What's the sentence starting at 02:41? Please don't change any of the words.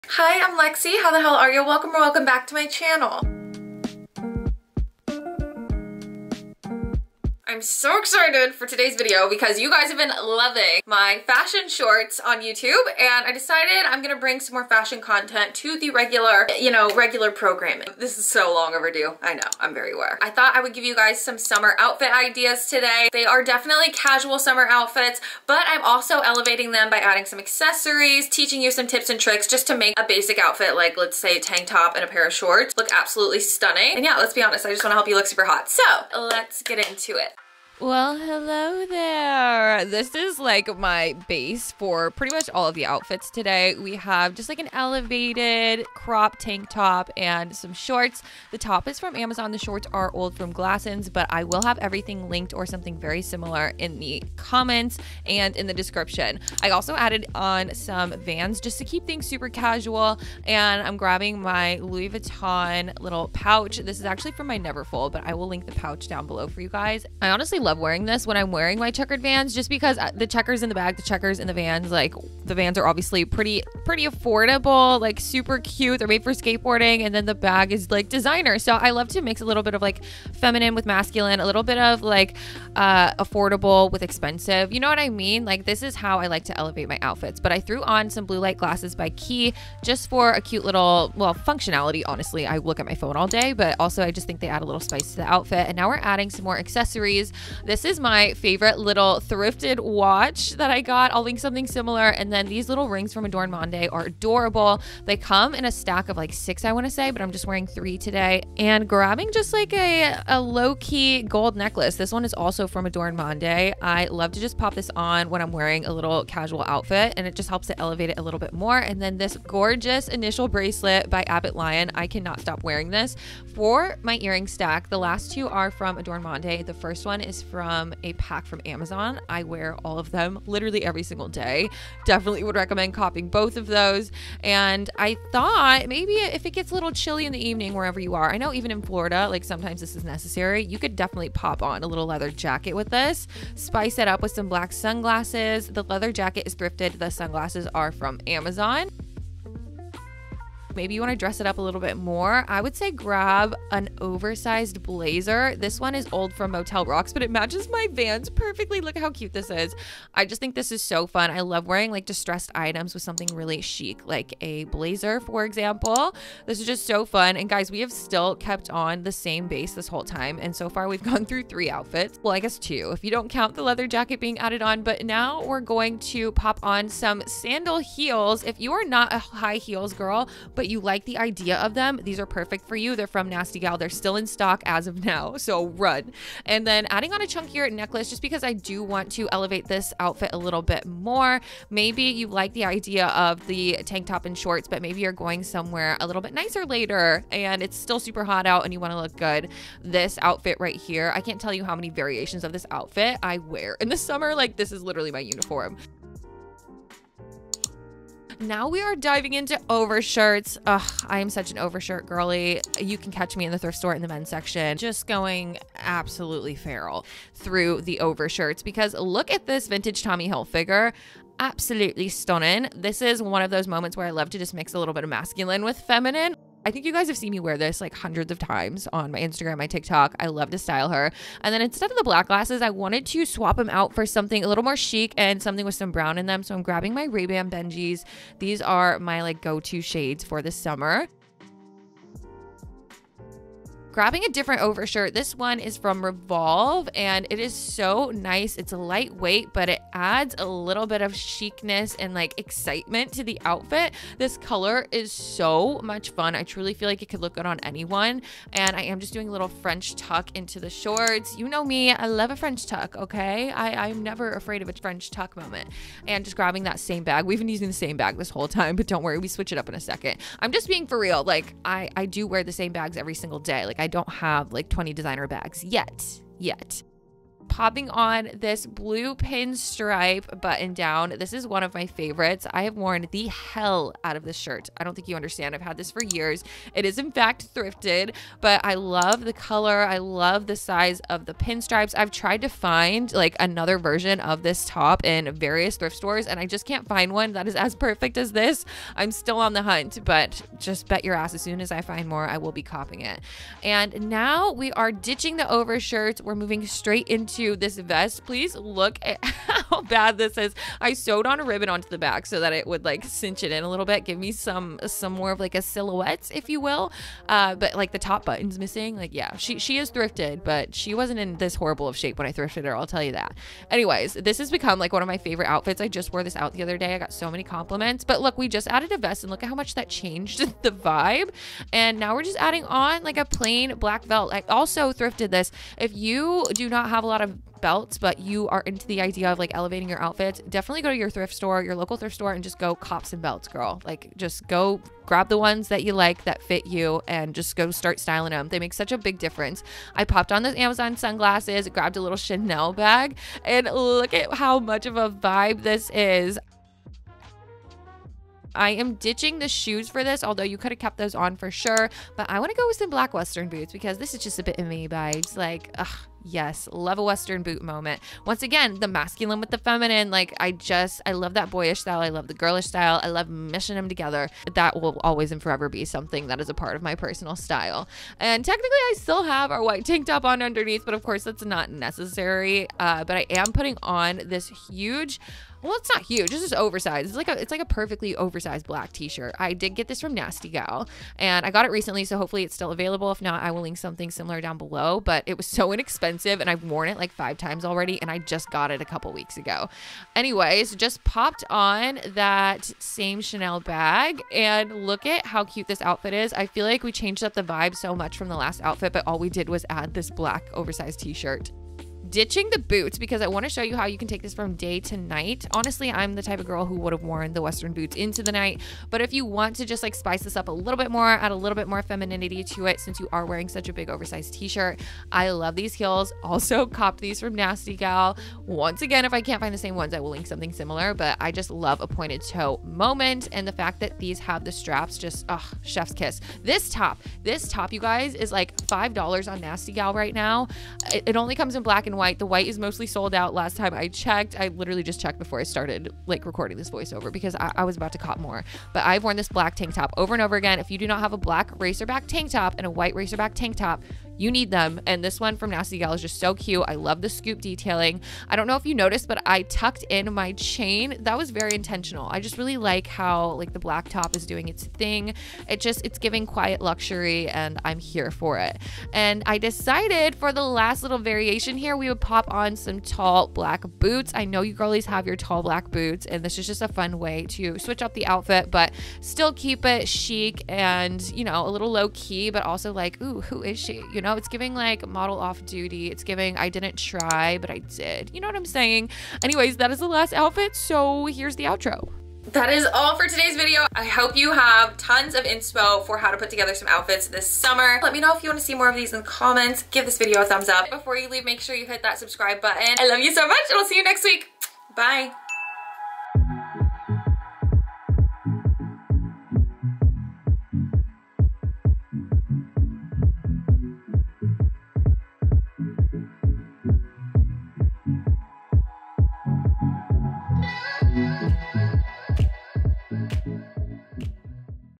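I love wearing like distressed items with something really chic, like a blazer, for example.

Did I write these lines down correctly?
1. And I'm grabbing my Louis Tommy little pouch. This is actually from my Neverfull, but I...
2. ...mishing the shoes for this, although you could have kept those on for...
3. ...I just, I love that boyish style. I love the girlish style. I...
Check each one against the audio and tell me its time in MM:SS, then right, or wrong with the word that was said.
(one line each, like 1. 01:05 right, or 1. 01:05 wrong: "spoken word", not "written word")
1. 01:00 wrong: "Vuitton", not "Tommy"
2. 05:58 wrong: "ditching", not "mishing"
3. 06:10 right.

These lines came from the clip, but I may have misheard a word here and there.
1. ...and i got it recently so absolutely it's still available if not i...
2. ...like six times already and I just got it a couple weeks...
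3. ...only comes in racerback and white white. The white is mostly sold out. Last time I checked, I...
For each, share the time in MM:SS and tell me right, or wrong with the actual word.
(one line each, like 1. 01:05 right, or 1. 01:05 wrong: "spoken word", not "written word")
1. 06:31 wrong: "hopefully", not "absolutely"
2. 06:36 wrong: "five", not "six"
3. 07:21 wrong: "black", not "racerback".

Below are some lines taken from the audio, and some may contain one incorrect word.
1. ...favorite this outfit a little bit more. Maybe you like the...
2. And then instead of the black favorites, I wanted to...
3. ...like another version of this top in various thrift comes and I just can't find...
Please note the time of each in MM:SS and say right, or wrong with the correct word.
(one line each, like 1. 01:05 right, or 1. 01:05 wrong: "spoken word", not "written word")
1. 03:09 wrong: "elevate", not "favorite"
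2. 03:51 wrong: "glasses", not "favorites"
3. 04:53 wrong: "stores", not "comes".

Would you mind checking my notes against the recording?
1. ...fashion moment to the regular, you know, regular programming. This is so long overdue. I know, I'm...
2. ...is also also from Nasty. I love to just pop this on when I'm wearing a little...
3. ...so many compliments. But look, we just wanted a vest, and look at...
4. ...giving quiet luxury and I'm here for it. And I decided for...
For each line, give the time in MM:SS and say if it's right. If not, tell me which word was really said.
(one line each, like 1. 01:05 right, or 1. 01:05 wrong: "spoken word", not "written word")
1. 00:14 wrong: "content", not "moment"
2. 01:52 wrong: "Adornmonde", not "Nasty"
3. 05:27 wrong: "added", not "wanted"
4. 07:45 right.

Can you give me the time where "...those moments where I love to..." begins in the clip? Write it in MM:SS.
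03:43.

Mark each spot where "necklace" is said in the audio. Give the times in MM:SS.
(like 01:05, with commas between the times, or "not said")
01:51, 03:07.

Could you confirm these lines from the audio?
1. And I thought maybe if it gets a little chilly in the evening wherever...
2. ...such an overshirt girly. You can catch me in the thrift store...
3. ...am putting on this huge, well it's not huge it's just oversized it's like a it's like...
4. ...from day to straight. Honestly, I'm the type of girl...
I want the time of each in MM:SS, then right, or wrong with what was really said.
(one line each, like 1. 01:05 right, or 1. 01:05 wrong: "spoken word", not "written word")
1. 02:14 right
2. 03:31 right
3. 06:23 right
4. 06:54 wrong: "night", not "straight".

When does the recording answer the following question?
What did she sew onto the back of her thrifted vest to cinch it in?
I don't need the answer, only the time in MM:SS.
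05:11.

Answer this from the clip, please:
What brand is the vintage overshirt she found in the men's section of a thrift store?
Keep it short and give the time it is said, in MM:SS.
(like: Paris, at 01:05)
Tommy Hilfiger, at 03:40.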